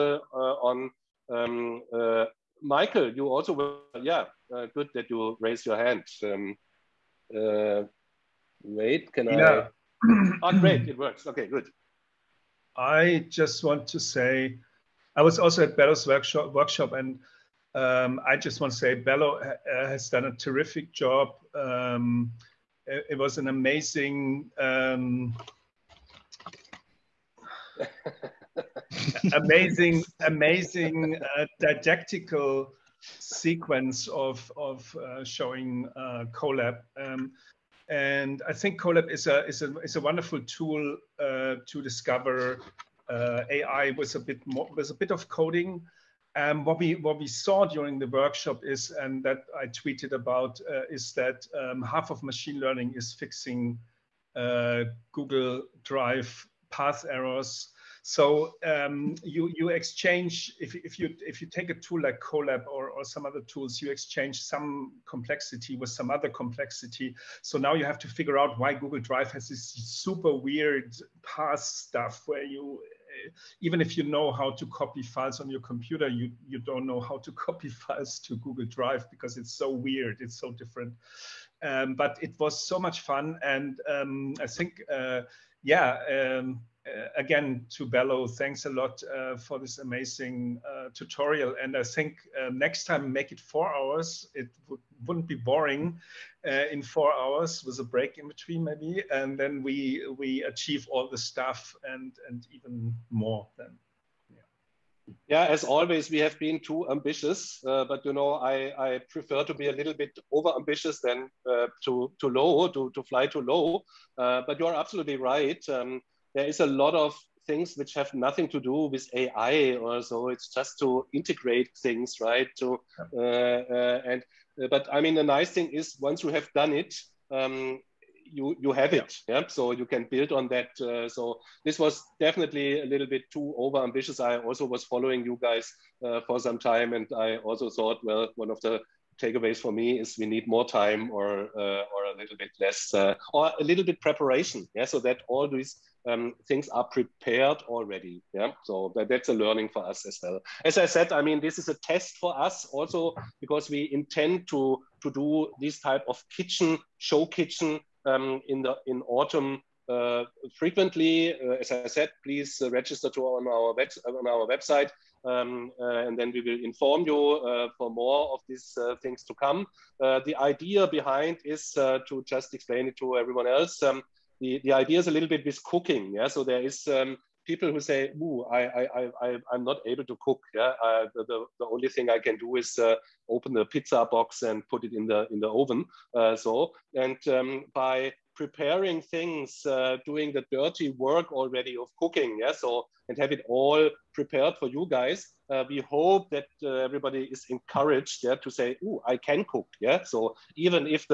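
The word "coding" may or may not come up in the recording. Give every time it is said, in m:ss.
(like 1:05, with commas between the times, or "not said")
0:45.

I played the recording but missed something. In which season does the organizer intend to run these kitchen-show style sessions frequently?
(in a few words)
Autumn.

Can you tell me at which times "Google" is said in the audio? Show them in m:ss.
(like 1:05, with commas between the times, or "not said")
0:55, 1:08, 1:18.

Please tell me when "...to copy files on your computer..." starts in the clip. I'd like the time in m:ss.
1:14.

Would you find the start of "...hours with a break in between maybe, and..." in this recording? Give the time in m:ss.
1:37.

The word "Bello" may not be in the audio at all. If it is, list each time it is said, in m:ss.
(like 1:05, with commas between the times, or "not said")
0:18, 1:27.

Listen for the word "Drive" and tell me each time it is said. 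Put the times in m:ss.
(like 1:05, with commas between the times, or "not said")
0:55, 1:08, 1:18.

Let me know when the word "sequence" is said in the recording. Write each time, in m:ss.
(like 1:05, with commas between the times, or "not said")
0:33.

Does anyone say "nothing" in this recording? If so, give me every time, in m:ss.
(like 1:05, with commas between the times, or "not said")
1:58.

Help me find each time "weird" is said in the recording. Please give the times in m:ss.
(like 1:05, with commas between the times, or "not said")
1:10, 1:19.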